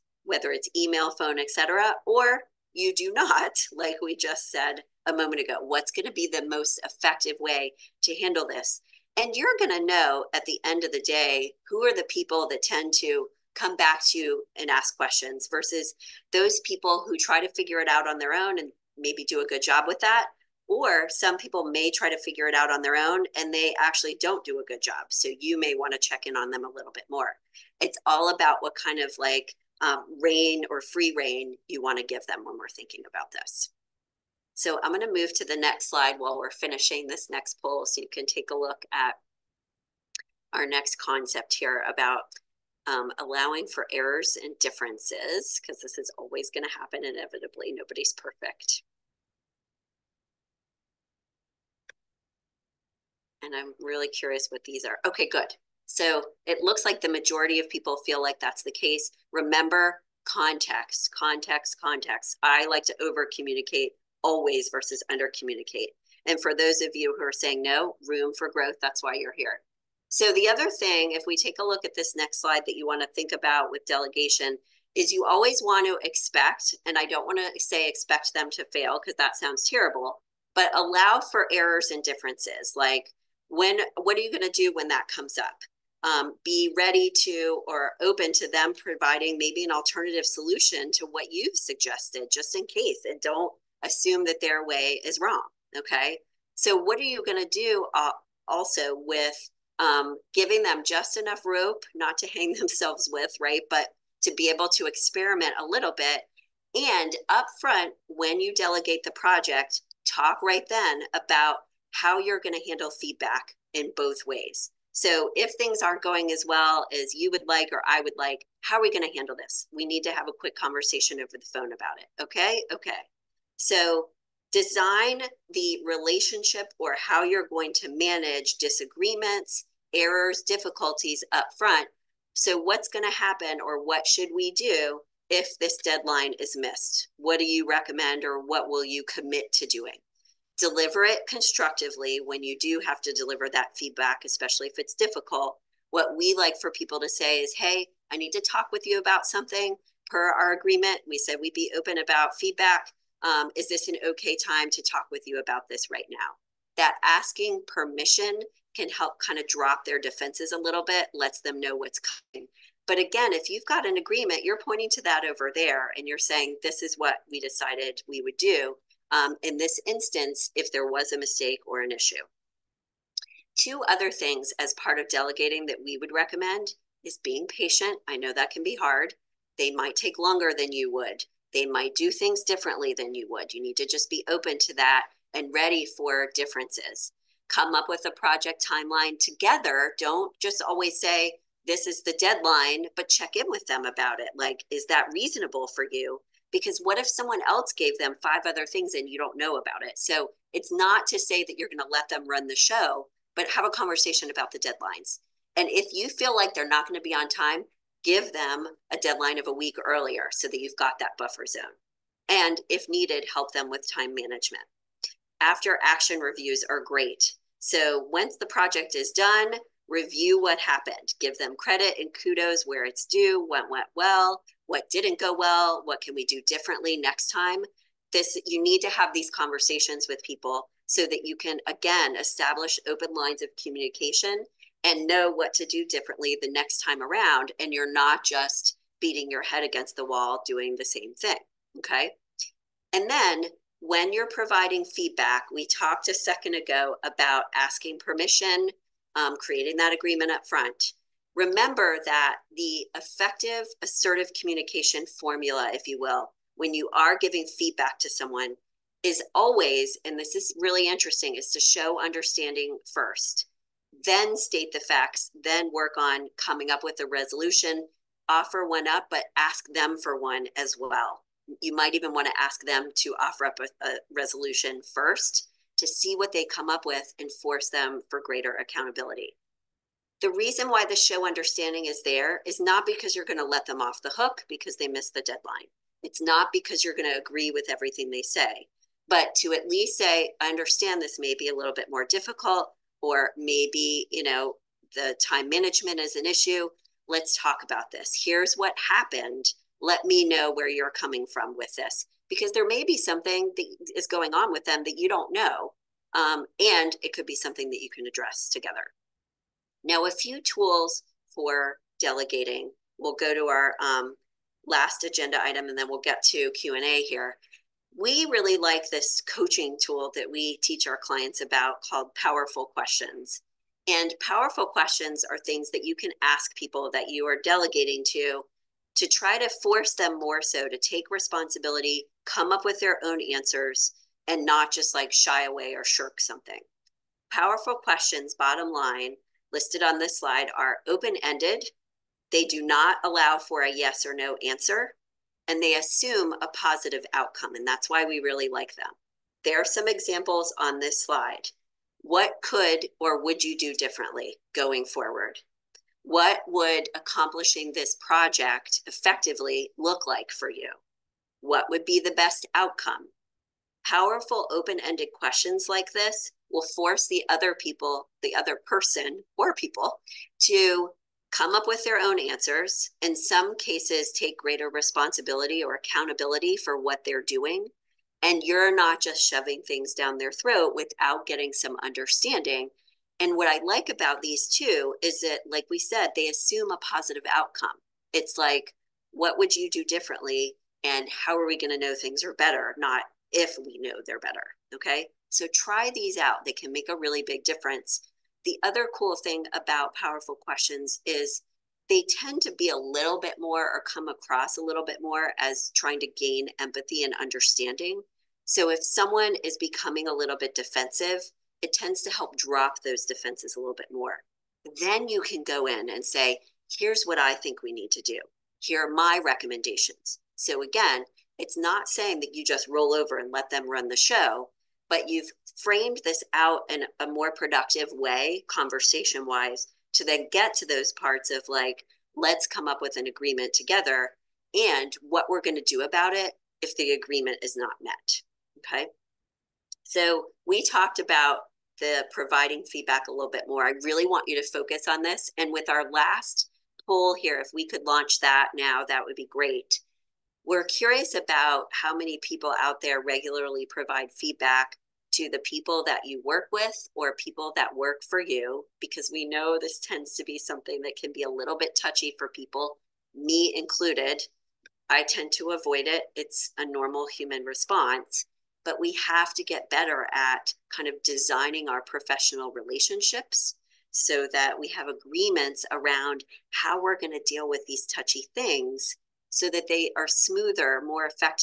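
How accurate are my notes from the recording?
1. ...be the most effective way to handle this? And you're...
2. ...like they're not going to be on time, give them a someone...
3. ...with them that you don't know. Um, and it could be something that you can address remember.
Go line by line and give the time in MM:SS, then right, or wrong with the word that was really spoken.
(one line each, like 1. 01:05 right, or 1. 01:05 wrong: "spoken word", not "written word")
1. 00:06 right
2. 03:26 wrong: "deadline", not "someone"
3. 05:04 wrong: "together", not "remember".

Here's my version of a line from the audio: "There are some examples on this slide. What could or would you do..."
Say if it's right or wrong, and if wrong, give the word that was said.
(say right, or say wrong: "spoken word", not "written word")
right.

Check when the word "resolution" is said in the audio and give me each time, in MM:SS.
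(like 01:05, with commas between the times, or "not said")
04:27, 04:34.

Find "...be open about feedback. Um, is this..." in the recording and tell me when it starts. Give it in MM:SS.
02:31.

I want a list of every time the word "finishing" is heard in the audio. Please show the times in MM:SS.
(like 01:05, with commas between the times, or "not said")
00:36.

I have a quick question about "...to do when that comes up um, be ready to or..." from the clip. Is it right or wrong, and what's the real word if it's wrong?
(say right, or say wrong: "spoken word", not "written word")
right.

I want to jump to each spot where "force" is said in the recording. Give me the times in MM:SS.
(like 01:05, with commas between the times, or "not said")
04:37, 05:29, 06:06.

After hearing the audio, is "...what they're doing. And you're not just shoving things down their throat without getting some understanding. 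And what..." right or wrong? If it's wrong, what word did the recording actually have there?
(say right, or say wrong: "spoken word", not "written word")
right.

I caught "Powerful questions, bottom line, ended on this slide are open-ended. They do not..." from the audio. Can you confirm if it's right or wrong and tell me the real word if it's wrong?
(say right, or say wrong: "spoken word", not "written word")
wrong: "listed", not "ended".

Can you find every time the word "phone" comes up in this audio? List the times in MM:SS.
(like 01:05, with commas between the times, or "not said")
00:01, 02:01.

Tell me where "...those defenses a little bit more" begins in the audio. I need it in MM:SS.
06:52.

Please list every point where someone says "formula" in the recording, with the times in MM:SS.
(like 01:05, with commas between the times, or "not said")
04:15.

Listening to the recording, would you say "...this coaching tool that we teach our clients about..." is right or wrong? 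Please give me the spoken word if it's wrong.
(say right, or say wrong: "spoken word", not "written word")
right.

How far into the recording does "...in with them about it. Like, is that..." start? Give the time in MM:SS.
03:13.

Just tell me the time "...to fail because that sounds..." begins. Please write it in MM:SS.
01:18.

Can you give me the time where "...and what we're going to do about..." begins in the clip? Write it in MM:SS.
07:14.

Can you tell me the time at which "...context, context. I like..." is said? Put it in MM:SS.
01:01.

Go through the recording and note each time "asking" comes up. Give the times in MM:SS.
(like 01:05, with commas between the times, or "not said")
02:37, 04:07.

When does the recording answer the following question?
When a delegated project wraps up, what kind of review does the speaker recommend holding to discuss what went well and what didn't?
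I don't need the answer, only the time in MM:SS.
03:35.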